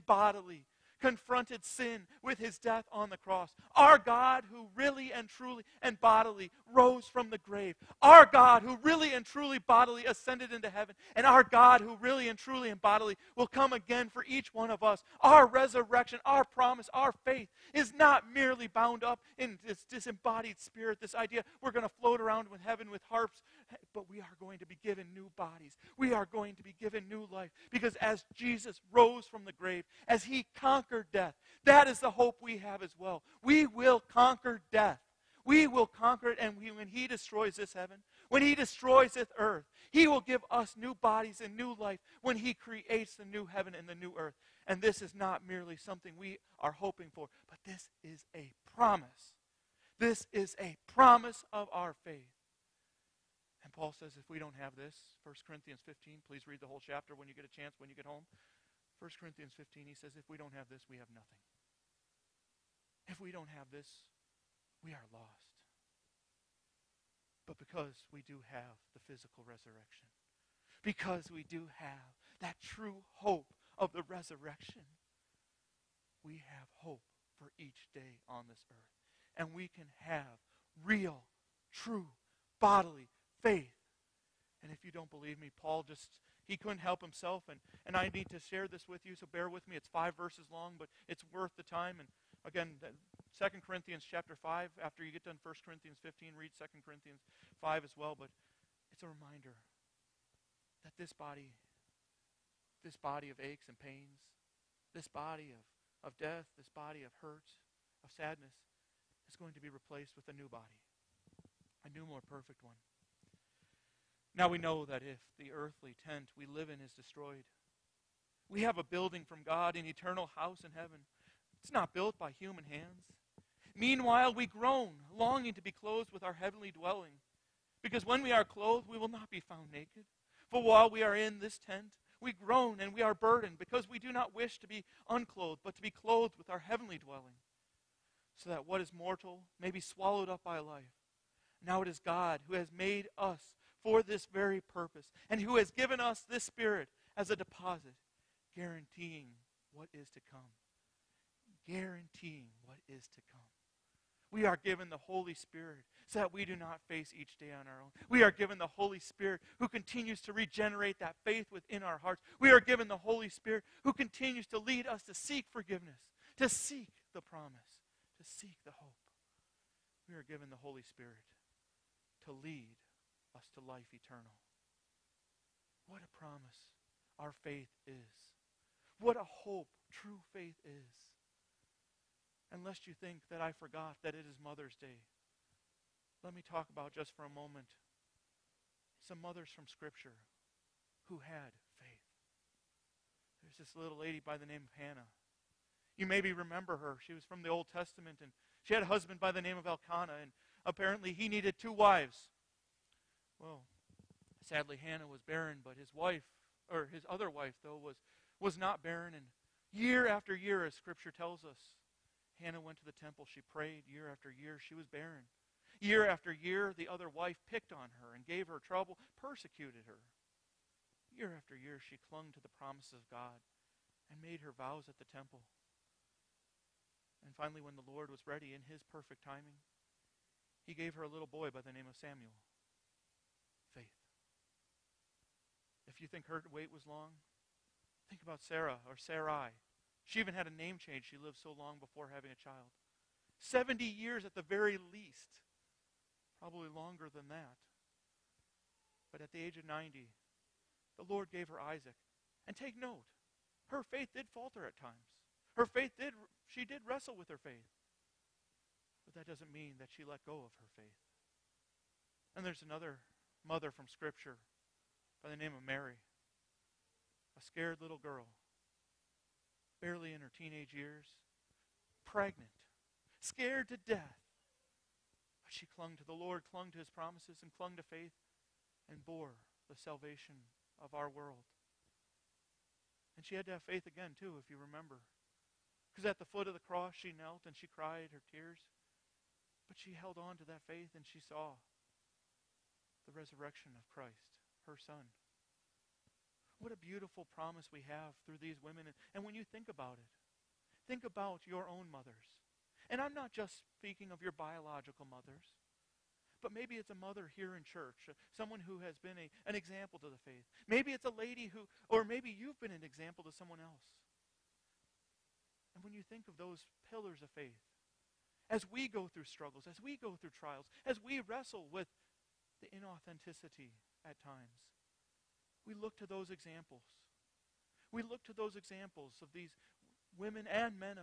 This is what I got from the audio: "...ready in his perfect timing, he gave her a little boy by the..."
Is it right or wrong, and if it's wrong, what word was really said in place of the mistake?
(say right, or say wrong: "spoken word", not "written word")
right.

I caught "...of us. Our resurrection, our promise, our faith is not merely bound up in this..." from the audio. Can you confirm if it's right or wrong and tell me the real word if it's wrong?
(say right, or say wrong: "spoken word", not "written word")
right.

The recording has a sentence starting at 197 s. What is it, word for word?
She was from the Old Testament, and she had a husband by the name of Elkanah, and apparently he needed two wives.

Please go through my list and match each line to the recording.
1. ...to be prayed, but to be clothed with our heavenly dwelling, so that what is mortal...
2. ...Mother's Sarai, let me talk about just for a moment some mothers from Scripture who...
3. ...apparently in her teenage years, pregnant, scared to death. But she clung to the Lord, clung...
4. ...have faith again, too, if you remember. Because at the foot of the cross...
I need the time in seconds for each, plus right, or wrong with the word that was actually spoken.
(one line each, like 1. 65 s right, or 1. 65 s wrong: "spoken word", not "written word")
1. 134 s wrong: "unclothed", not "prayed"
2. 184 s wrong: "Day", not "Sarai"
3. 269 s wrong: "barely", not "apparently"
4. 283 s right.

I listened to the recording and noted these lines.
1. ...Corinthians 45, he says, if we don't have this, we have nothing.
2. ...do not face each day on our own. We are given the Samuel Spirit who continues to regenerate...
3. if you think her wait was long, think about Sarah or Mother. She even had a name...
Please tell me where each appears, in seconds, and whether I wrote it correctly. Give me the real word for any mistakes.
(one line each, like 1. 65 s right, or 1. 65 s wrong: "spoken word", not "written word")
1. 59 s wrong: "15", not "45"
2. 156 s wrong: "Holy", not "Samuel"
3. 235 s wrong: "Sarai", not "Mother".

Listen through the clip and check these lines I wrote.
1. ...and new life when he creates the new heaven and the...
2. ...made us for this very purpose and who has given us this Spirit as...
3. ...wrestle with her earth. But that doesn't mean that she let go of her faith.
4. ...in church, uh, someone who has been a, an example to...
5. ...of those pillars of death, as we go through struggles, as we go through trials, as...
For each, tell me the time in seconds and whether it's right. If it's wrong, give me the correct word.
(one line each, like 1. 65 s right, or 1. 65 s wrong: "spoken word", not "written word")
1. 41 s right
2. 142 s right
3. 256 s wrong: "faith", not "earth"
4. 307 s right
5. 316 s wrong: "faith", not "death".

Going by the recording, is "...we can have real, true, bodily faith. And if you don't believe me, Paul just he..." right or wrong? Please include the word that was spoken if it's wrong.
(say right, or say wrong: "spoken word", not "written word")
right.